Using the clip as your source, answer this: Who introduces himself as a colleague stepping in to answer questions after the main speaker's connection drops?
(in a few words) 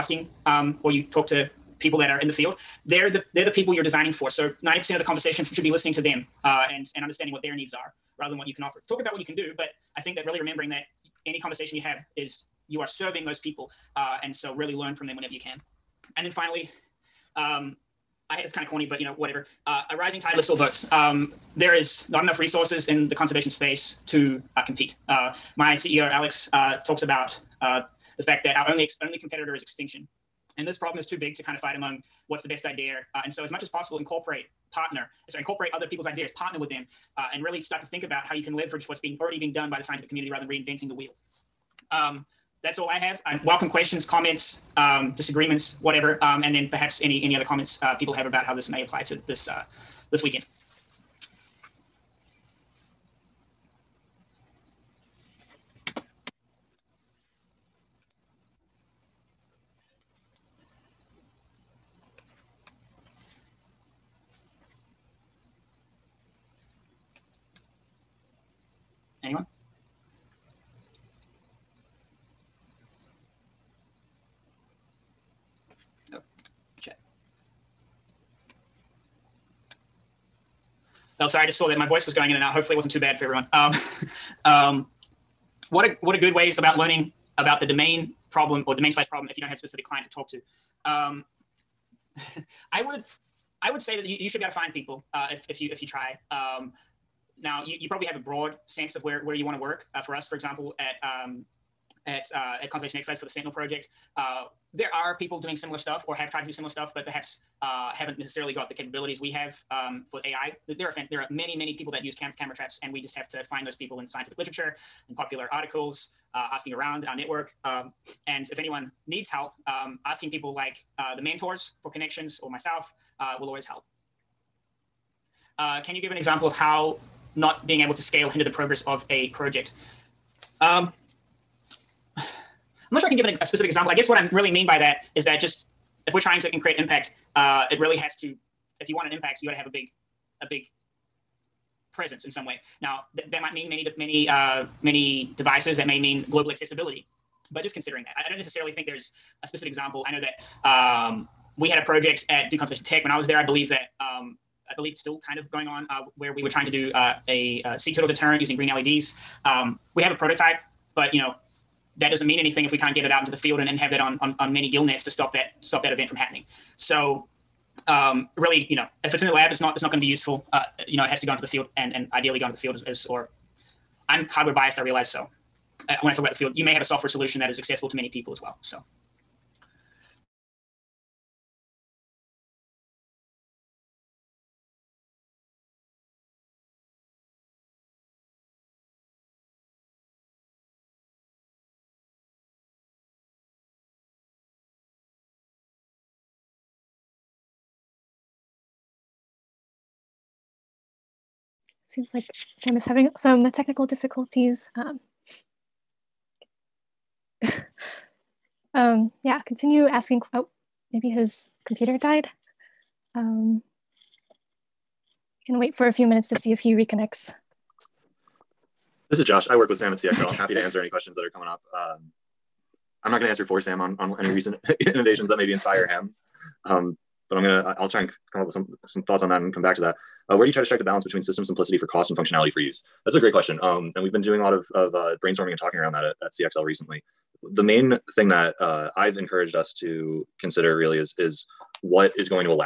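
Josh.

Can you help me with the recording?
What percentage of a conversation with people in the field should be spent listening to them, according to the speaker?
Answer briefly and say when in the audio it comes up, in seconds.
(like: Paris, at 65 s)
90%, at 4 s.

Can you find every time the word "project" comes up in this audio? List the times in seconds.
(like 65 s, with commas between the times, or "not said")
103 s, 129 s, 151 s.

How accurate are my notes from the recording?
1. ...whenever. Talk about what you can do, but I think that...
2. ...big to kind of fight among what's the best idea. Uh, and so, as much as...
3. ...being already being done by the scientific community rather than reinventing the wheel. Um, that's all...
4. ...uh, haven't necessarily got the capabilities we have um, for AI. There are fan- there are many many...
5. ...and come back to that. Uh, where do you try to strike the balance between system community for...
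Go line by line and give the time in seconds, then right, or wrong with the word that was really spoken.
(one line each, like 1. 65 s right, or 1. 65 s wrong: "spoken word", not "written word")
1. 8 s wrong: "offer", not "whenever"
2. 31 s right
3. 38 s right
4. 107 s right
5. 229 s wrong: "simplicity", not "community".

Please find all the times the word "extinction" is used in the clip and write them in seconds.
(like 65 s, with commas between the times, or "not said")
29 s.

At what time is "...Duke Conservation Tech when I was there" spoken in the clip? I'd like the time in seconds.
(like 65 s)
152 s.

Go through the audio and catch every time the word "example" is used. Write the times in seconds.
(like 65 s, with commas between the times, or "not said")
100 s, 126 s, 133 s, 149 s.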